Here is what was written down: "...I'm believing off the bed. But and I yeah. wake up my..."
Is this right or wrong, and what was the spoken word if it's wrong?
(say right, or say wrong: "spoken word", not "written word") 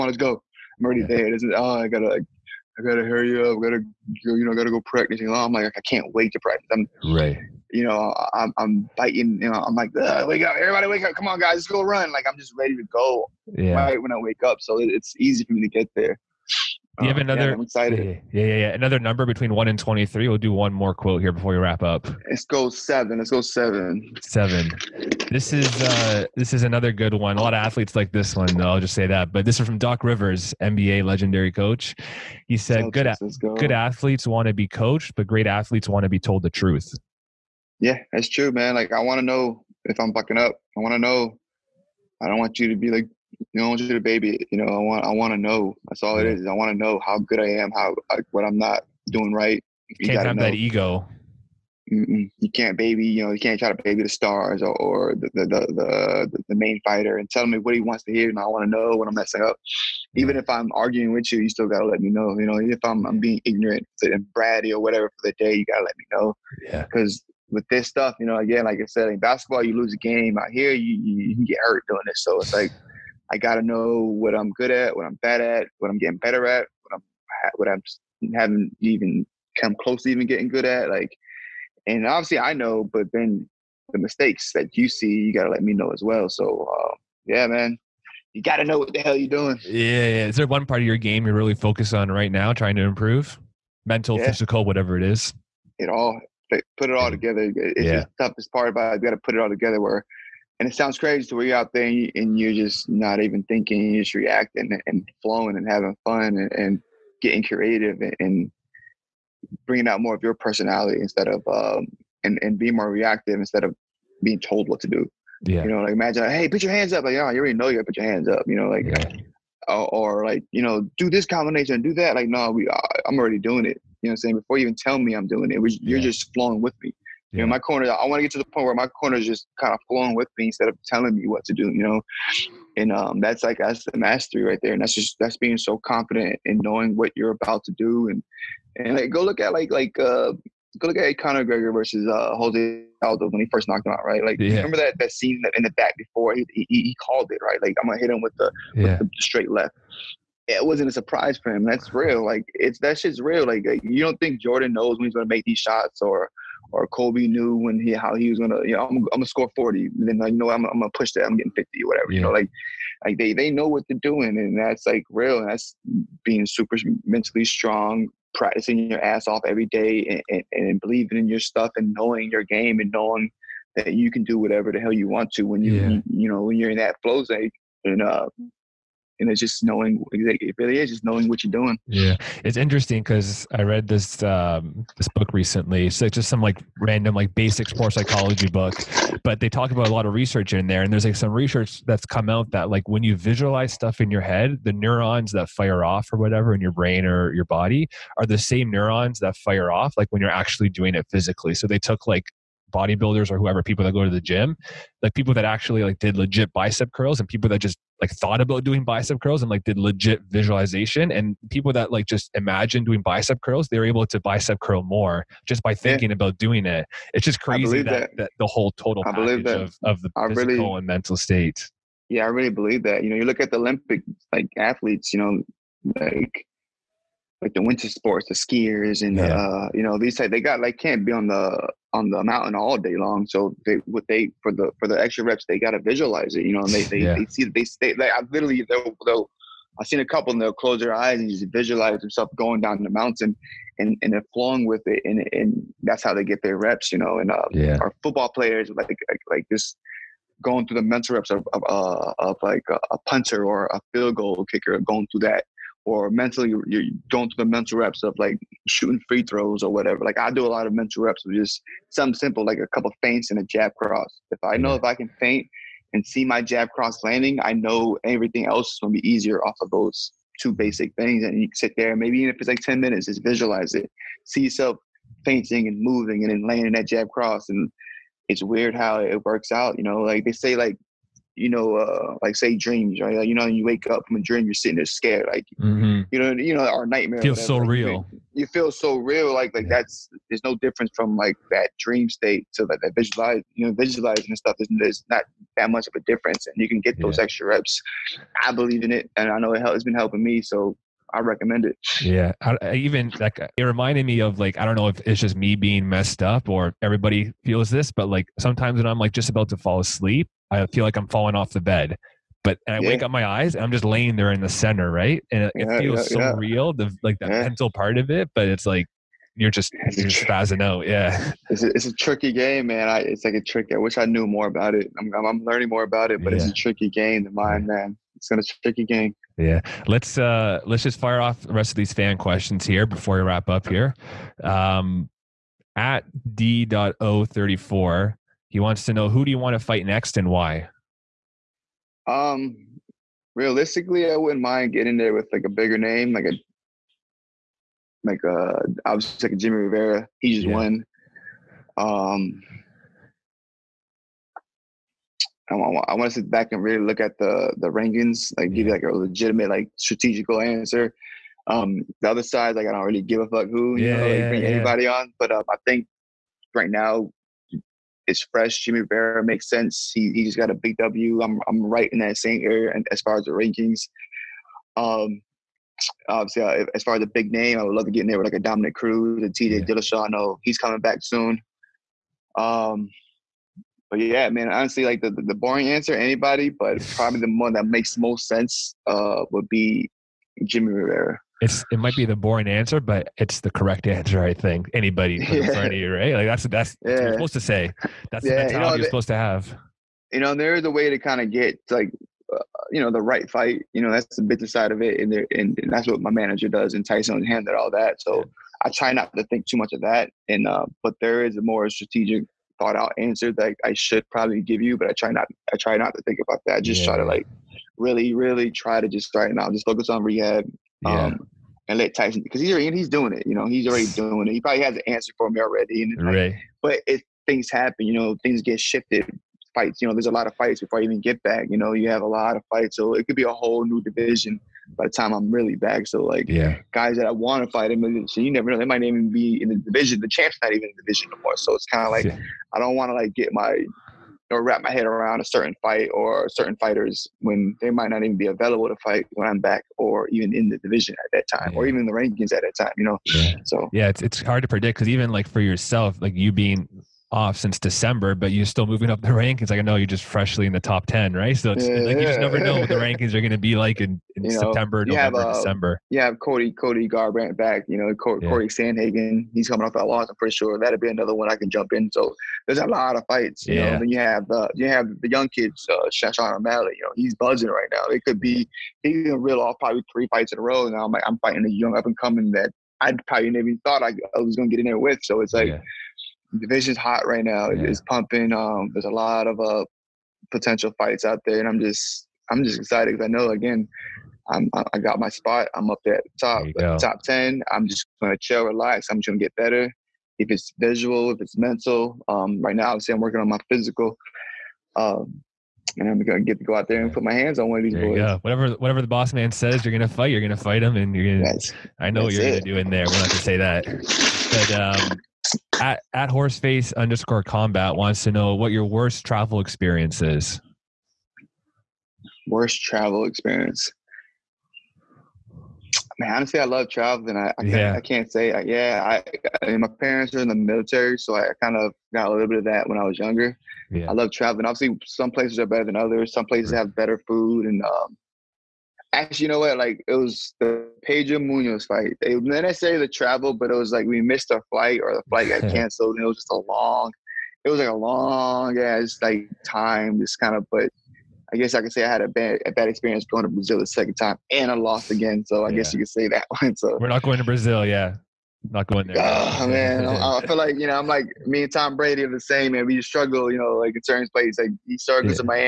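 wrong: "falling", not "believing".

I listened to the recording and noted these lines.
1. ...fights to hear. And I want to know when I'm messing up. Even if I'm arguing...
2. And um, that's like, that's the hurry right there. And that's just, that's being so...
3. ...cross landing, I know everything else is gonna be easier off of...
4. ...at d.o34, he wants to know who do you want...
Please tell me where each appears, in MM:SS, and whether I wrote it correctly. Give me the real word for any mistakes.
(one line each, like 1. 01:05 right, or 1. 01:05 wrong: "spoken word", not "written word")
1. 00:57 wrong: "wants", not "fights"
2. 02:12 wrong: "mastery", not "hurry"
3. 04:26 right
4. 05:35 right.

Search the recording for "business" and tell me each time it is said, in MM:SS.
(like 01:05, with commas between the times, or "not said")
06:44.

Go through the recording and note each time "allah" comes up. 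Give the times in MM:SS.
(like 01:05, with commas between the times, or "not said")
not said.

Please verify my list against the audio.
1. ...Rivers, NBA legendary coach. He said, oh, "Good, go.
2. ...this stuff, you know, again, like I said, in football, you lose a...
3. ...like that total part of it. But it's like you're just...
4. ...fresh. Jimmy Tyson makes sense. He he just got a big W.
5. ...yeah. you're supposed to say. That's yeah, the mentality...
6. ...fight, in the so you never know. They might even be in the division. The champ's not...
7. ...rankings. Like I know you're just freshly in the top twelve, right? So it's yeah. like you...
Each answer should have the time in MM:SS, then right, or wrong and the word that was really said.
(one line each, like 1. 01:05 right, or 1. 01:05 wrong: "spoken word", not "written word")
1. 00:30 right
2. 01:07 wrong: "basketball", not "football"
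3. 05:17 wrong: "mental", not "total"
4. 06:08 wrong: "Rivera", not "Tyson"
5. 06:36 right
6. 07:17 right
7. 07:39 wrong: "ten", not "twelve".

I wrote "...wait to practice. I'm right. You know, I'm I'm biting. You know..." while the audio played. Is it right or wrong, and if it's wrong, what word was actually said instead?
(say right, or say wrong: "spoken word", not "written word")
right.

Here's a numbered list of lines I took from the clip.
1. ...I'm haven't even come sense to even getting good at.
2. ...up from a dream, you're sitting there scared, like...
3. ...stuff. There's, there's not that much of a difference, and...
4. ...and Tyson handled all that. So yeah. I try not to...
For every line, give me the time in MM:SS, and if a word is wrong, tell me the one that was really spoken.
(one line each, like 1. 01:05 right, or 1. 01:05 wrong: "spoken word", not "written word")
1. 01:17 wrong: "close", not "sense"
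2. 04:43 right
3. 04:54 right
4. 06:46 right.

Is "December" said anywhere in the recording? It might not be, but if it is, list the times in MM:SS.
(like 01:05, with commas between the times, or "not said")
07:37, 07:45.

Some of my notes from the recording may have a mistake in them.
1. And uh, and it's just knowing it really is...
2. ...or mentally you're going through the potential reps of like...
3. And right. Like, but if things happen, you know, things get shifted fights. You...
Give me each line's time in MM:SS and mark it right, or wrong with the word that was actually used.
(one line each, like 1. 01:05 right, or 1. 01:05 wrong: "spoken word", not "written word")
1. 02:57 right
2. 04:15 wrong: "mental", not "potential"
3. 07:05 right.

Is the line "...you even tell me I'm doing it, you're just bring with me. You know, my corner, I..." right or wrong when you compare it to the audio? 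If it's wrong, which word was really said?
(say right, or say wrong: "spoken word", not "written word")
wrong: "flowing", not "bring".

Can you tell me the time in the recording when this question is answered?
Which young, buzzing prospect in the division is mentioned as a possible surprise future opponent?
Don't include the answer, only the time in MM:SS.
07:55.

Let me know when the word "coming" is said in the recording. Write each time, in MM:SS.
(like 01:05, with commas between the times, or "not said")
06:20, 07:49, 08:01.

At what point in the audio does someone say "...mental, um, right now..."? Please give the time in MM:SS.
08:21.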